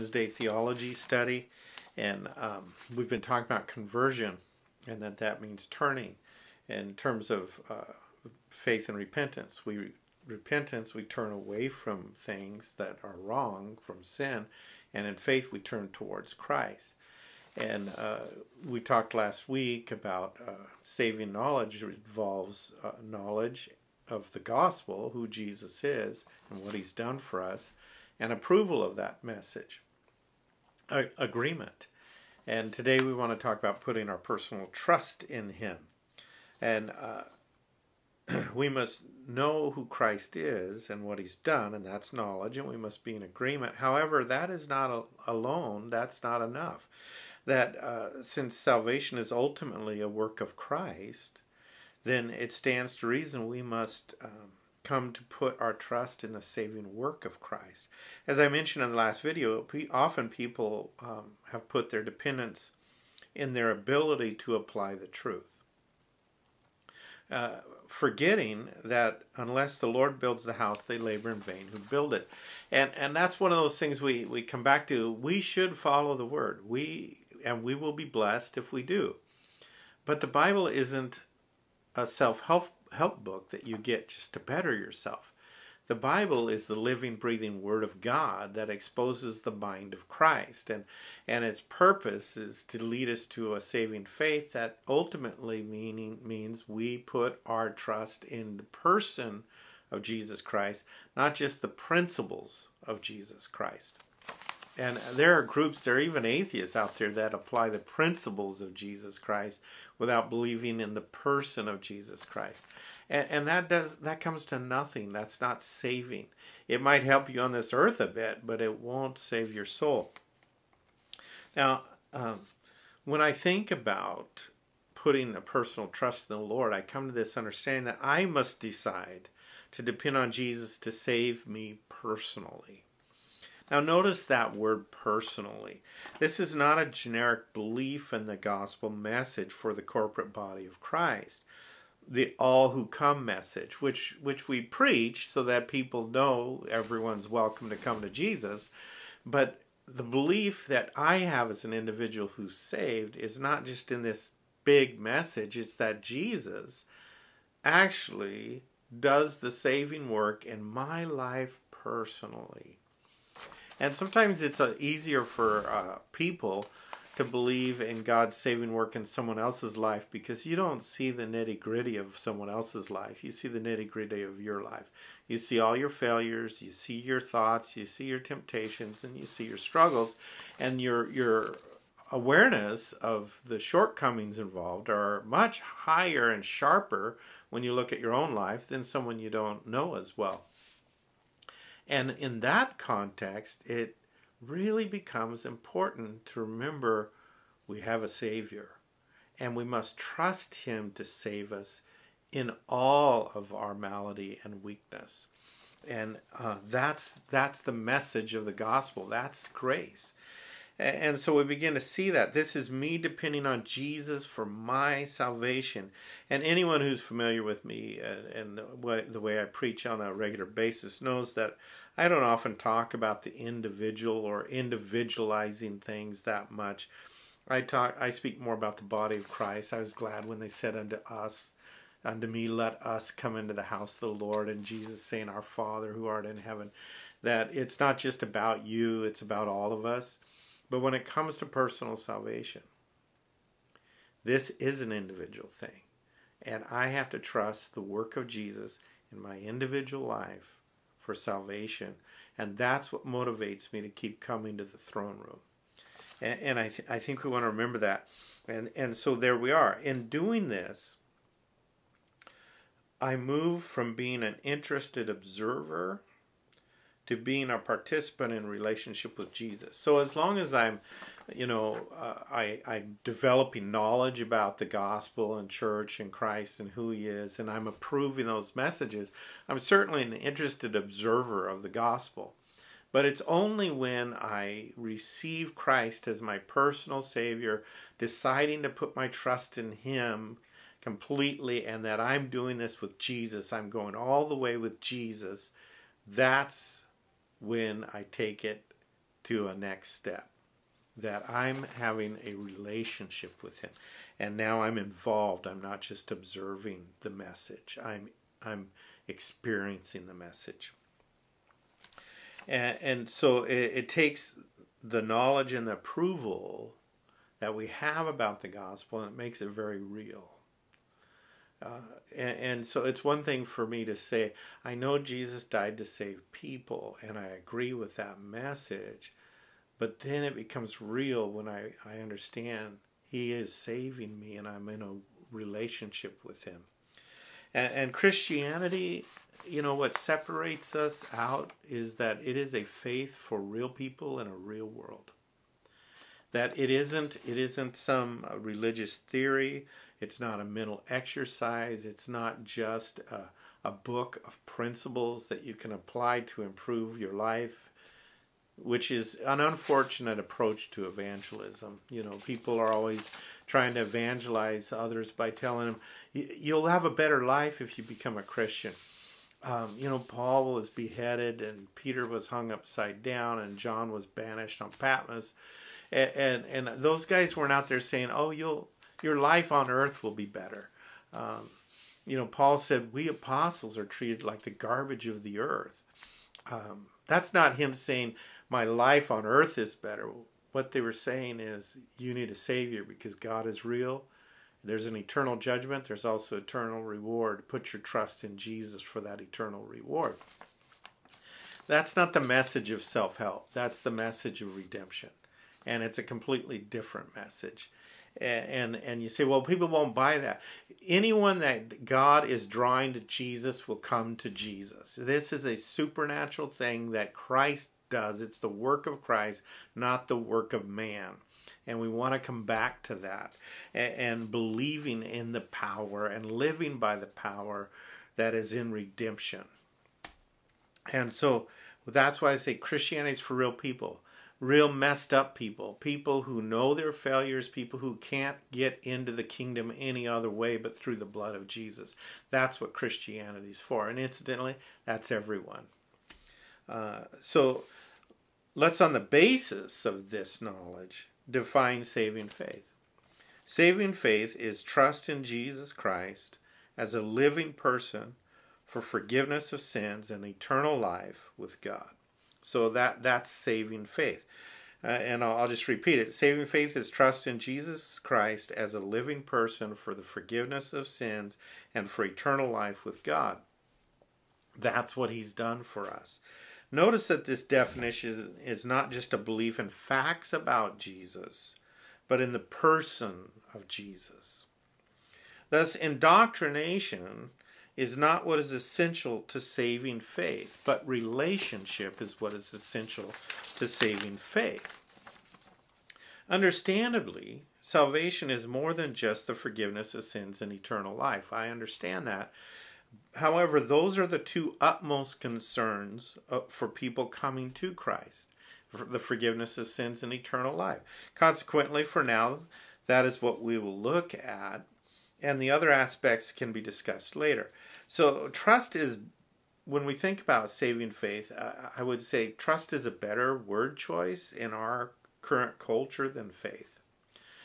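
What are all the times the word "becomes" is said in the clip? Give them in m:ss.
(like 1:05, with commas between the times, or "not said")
3:14, 5:30, 6:07.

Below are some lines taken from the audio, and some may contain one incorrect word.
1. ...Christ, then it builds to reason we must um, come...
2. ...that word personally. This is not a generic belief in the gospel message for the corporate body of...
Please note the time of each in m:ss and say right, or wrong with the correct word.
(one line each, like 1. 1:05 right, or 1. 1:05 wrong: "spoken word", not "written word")
1. 0:50 wrong: "stands", not "builds"
2. 2:14 right.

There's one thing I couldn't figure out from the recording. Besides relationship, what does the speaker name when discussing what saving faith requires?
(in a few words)
indoctrination.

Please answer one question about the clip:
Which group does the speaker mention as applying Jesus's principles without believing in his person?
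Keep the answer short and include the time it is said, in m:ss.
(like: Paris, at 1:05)
atheists, at 1:46.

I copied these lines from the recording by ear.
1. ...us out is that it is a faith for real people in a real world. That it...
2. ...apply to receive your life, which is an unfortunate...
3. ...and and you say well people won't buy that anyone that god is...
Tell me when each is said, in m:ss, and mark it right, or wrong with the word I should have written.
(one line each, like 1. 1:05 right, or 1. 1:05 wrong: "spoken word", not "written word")
1. 5:40 right
2. 5:55 wrong: "improve", not "receive"
3. 6:48 right.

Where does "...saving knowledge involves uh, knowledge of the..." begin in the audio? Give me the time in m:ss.
0:20.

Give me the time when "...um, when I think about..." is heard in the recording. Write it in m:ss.
2:02.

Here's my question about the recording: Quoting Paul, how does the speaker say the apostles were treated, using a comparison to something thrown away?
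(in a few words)
garbage of the earth.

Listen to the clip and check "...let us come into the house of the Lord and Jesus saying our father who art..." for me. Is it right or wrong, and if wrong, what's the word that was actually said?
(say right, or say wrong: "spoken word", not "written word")
right.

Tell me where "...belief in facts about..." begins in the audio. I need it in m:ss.
7:59.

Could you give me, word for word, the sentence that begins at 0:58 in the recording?
As I mentioned in the last video, often people um, have put their dependence in their ability to apply the truth.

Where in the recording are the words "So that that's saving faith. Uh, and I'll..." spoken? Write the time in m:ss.
7:42.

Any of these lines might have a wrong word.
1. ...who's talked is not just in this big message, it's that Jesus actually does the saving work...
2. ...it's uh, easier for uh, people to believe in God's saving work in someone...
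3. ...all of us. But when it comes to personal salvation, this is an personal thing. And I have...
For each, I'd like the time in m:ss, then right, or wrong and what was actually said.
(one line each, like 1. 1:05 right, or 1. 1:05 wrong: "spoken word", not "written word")
1. 2:32 wrong: "saved", not "talked"
2. 2:44 right
3. 3:59 wrong: "individual", not "personal".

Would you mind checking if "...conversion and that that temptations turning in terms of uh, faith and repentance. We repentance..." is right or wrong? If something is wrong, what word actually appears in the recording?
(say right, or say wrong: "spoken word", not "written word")
wrong: "means", not "temptations".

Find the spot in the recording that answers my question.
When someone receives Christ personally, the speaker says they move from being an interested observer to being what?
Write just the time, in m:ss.
4:27.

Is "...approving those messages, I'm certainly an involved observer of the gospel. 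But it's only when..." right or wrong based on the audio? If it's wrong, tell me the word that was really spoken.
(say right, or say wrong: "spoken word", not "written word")
wrong: "interested", not "involved".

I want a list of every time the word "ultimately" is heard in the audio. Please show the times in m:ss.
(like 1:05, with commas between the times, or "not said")
0:49, 1:34.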